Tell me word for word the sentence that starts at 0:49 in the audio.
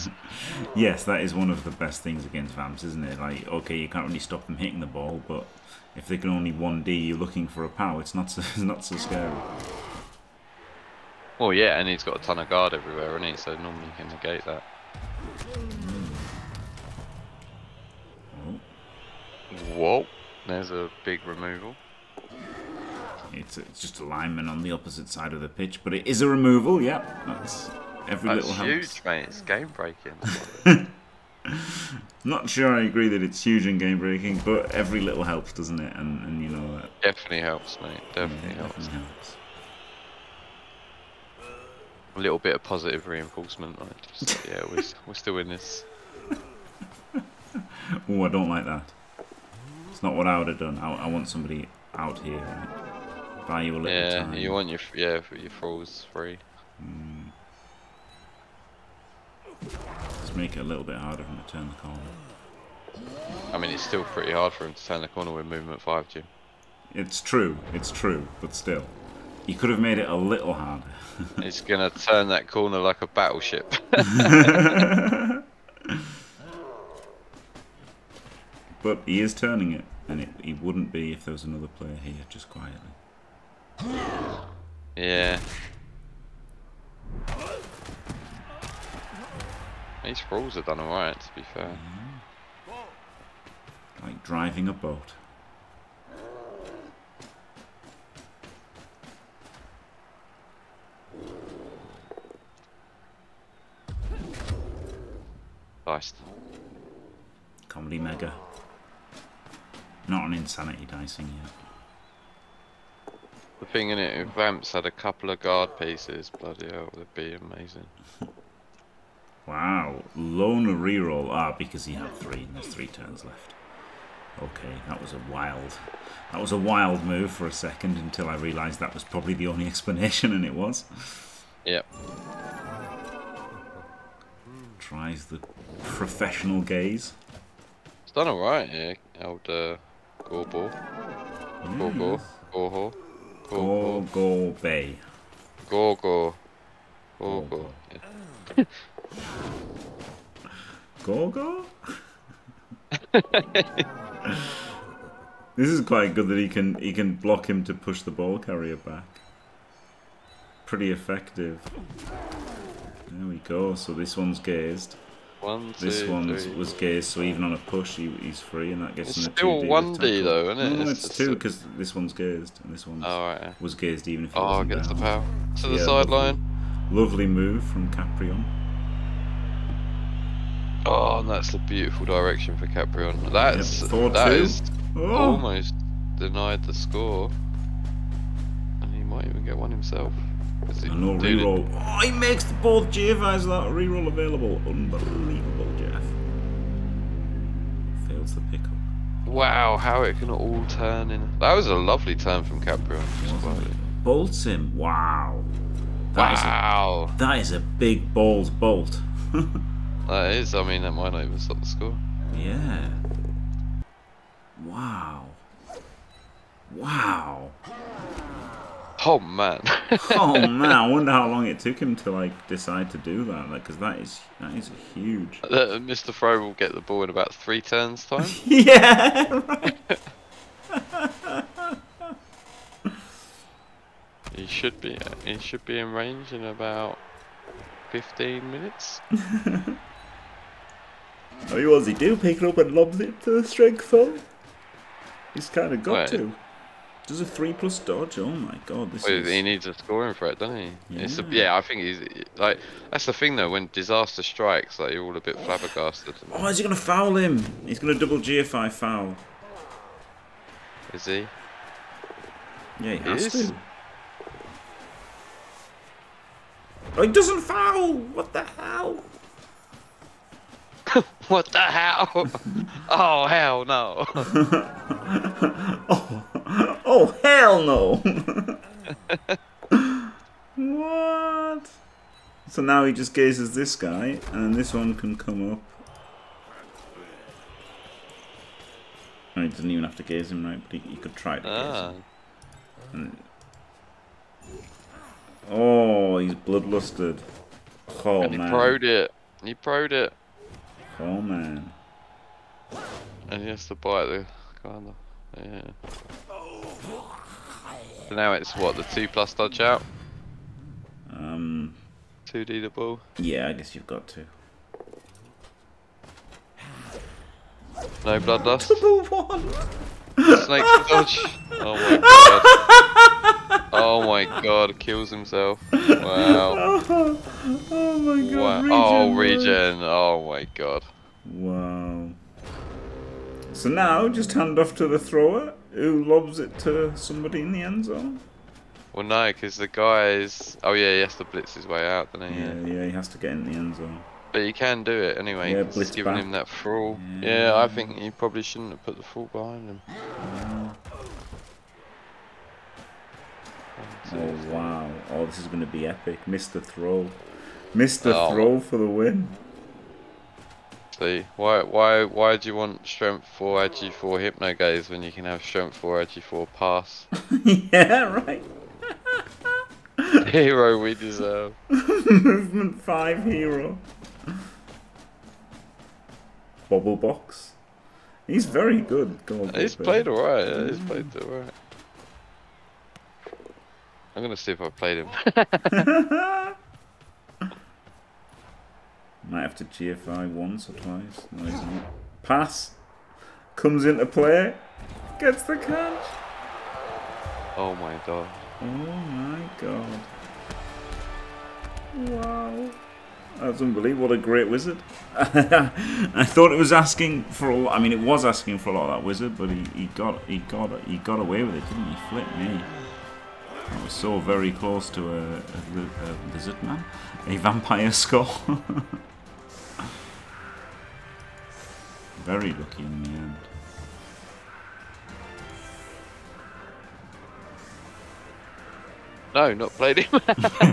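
It's not what I would have done.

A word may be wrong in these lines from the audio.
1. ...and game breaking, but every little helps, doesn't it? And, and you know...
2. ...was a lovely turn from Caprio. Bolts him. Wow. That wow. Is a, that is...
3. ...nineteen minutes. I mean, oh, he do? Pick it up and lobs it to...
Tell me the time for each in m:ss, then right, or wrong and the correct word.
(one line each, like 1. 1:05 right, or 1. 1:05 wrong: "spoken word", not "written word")
1. 0:33 right
2. 3:21 right
3. 3:57 wrong: "fifteen", not "nineteen".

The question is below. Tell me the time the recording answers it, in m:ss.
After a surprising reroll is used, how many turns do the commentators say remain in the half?
2:02.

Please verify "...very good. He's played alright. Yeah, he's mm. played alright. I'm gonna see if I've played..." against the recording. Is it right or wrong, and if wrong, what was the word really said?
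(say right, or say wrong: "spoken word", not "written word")
right.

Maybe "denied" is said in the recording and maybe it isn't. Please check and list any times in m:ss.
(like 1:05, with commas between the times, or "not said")
3:06.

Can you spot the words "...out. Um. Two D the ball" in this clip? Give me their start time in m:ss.
5:09.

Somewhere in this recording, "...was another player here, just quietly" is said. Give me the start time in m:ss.
1:21.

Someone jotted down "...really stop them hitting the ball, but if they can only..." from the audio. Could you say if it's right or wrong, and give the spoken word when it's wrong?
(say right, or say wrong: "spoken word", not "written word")
right.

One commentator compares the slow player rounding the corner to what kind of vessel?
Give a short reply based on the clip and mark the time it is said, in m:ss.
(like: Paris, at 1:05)
a battleship, at 1:13.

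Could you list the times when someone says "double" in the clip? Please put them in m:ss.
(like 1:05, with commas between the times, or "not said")
4:17, 5:18.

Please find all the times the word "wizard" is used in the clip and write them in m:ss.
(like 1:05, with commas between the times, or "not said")
6:44, 6:49.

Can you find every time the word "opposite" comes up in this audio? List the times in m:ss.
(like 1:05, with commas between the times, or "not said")
0:24.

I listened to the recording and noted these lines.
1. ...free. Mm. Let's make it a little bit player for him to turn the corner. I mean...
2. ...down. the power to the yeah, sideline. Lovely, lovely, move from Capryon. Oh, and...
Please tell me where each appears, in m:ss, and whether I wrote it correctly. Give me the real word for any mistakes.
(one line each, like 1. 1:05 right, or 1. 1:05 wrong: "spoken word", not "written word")
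1. 0:56 wrong: "harder", not "player"
2. 2:54 right.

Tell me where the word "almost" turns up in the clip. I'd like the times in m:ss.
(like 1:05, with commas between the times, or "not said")
3:05.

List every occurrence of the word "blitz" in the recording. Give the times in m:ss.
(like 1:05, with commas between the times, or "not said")
5:41, 5:45.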